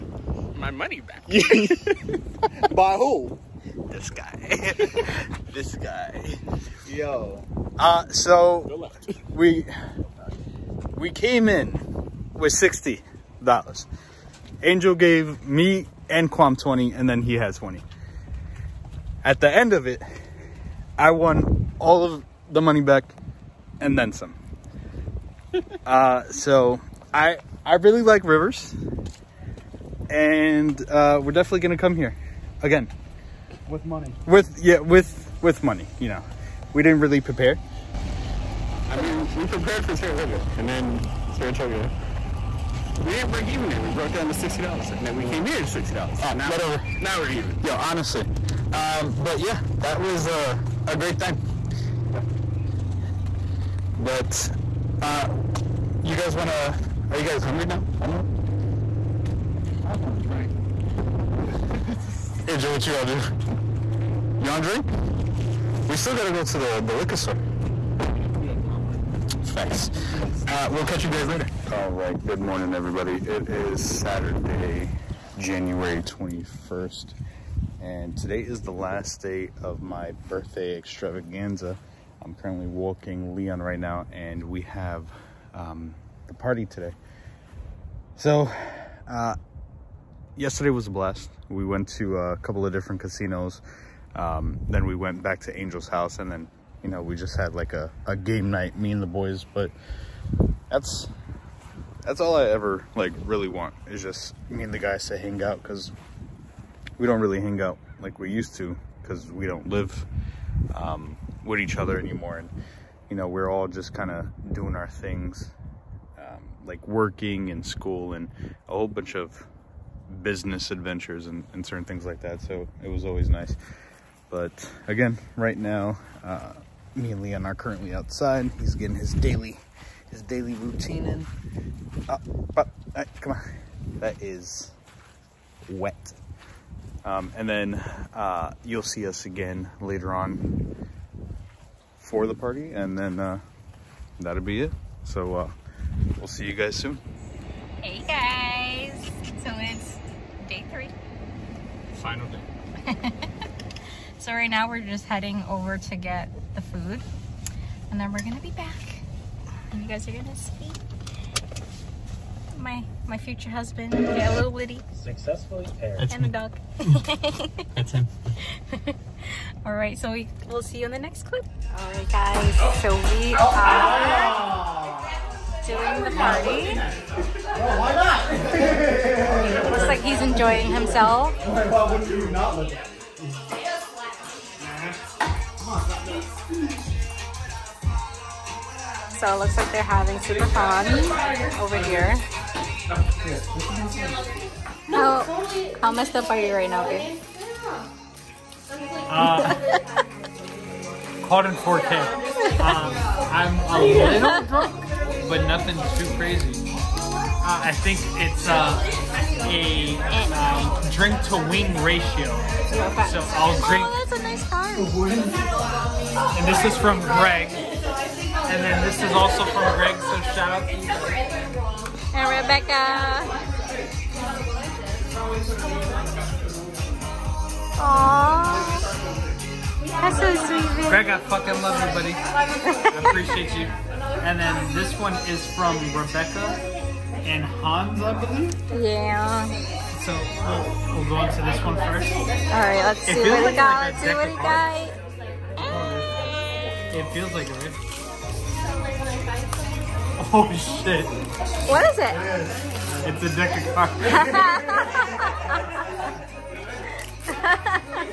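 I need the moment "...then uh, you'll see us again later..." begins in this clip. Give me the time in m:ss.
2:17.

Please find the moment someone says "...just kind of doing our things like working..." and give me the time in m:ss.
1:53.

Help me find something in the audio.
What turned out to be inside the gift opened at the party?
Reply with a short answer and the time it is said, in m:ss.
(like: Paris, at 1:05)
A deck of cards, at 4:13.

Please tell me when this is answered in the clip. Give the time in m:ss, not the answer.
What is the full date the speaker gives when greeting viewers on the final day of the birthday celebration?
1:13.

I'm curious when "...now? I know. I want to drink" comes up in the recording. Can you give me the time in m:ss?
0:57.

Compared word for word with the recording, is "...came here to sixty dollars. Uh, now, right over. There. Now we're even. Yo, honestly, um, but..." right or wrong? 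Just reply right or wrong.
right.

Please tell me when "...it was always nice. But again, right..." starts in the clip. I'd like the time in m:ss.
2:02.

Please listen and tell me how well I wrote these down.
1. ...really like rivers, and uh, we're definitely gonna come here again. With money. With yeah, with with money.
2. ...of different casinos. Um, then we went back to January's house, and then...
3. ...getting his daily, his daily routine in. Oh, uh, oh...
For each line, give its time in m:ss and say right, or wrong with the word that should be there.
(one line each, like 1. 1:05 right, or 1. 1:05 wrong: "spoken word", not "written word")
1. 0:27 right
2. 1:32 wrong: "Angel", not "January"
3. 2:08 right.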